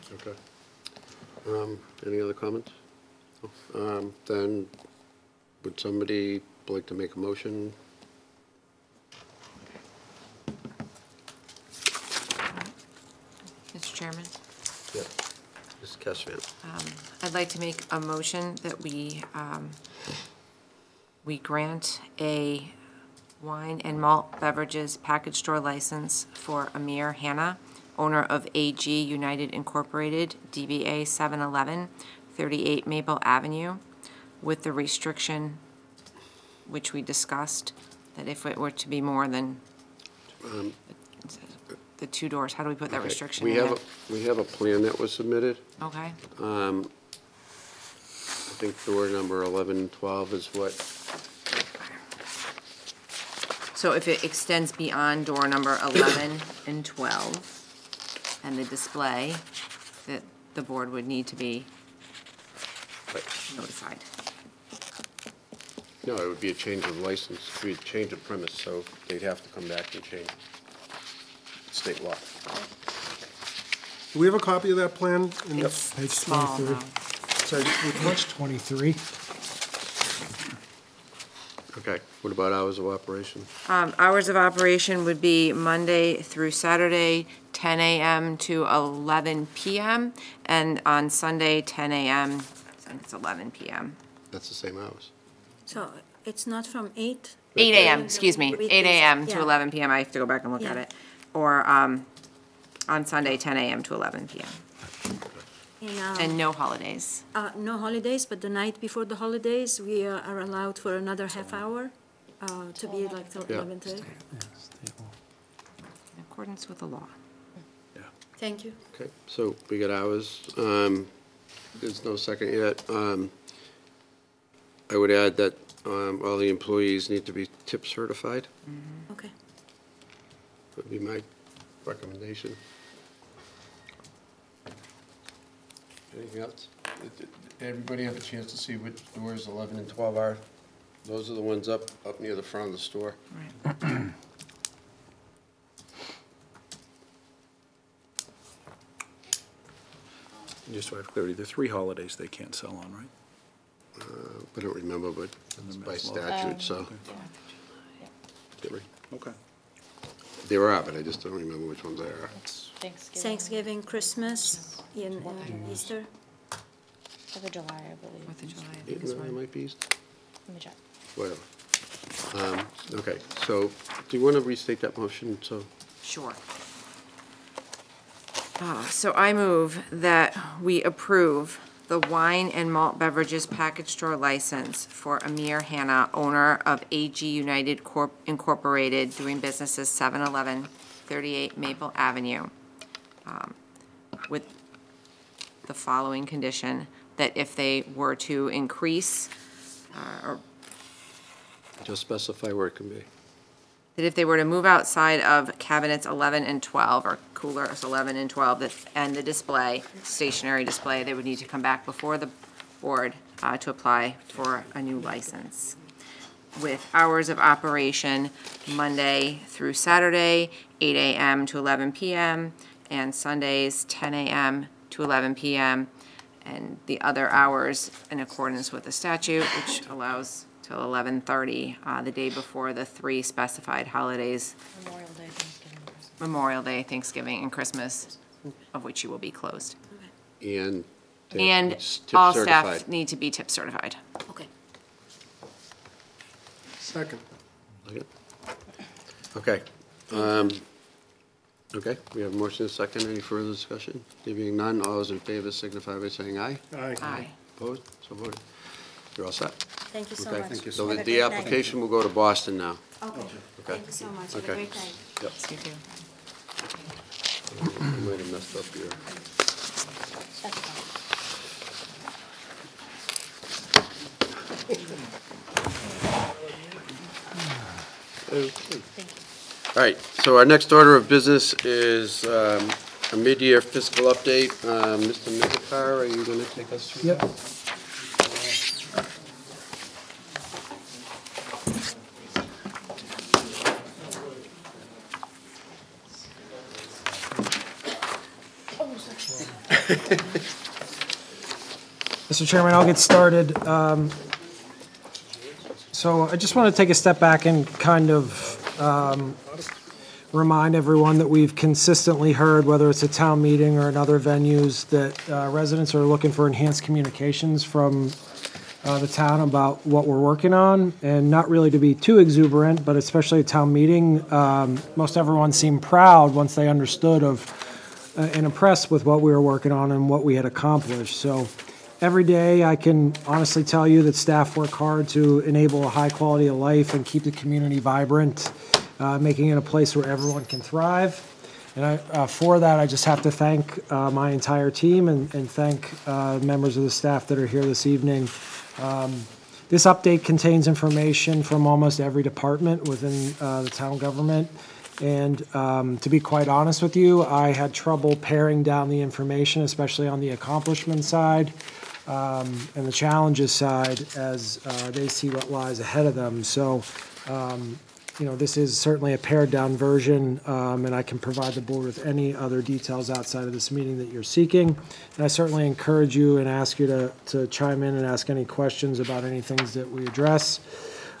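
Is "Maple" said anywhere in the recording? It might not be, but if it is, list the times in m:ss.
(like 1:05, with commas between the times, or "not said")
0:32, 3:11.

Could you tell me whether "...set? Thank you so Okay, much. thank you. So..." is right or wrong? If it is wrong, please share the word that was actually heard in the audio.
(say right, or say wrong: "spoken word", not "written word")
right.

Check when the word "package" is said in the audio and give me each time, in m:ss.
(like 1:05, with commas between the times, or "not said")
0:24, 3:03.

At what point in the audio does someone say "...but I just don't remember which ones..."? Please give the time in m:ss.
2:40.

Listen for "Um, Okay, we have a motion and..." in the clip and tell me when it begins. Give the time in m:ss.
4:10.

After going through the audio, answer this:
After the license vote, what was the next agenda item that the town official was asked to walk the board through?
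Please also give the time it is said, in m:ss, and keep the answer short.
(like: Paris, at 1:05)
mid-year fiscal update, at 4:43.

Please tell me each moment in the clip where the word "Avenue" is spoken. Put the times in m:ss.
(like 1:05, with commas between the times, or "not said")
0:33, 3:11.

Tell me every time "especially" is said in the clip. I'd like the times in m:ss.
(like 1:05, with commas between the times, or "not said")
5:22, 5:59.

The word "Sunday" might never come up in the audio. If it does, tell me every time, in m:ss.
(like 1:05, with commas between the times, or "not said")
1:31, 1:43, 3:43.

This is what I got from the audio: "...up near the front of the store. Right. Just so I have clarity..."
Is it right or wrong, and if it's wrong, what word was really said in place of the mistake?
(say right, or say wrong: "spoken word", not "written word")
right.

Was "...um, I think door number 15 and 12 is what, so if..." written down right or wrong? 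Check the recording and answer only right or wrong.
wrong.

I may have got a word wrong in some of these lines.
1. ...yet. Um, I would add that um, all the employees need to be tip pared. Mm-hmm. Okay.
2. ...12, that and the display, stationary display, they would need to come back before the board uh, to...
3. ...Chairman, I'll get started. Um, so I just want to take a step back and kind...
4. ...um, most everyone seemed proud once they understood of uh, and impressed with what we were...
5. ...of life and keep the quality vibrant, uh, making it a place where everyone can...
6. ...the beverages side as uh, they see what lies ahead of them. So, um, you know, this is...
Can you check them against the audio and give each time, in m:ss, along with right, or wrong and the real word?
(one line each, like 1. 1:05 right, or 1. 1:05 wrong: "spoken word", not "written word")
1. 2:02 wrong: "certified", not "pared"
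2. 3:28 right
3. 5:02 right
4. 5:24 right
5. 5:36 wrong: "community", not "quality"
6. 6:02 wrong: "challenges", not "beverages".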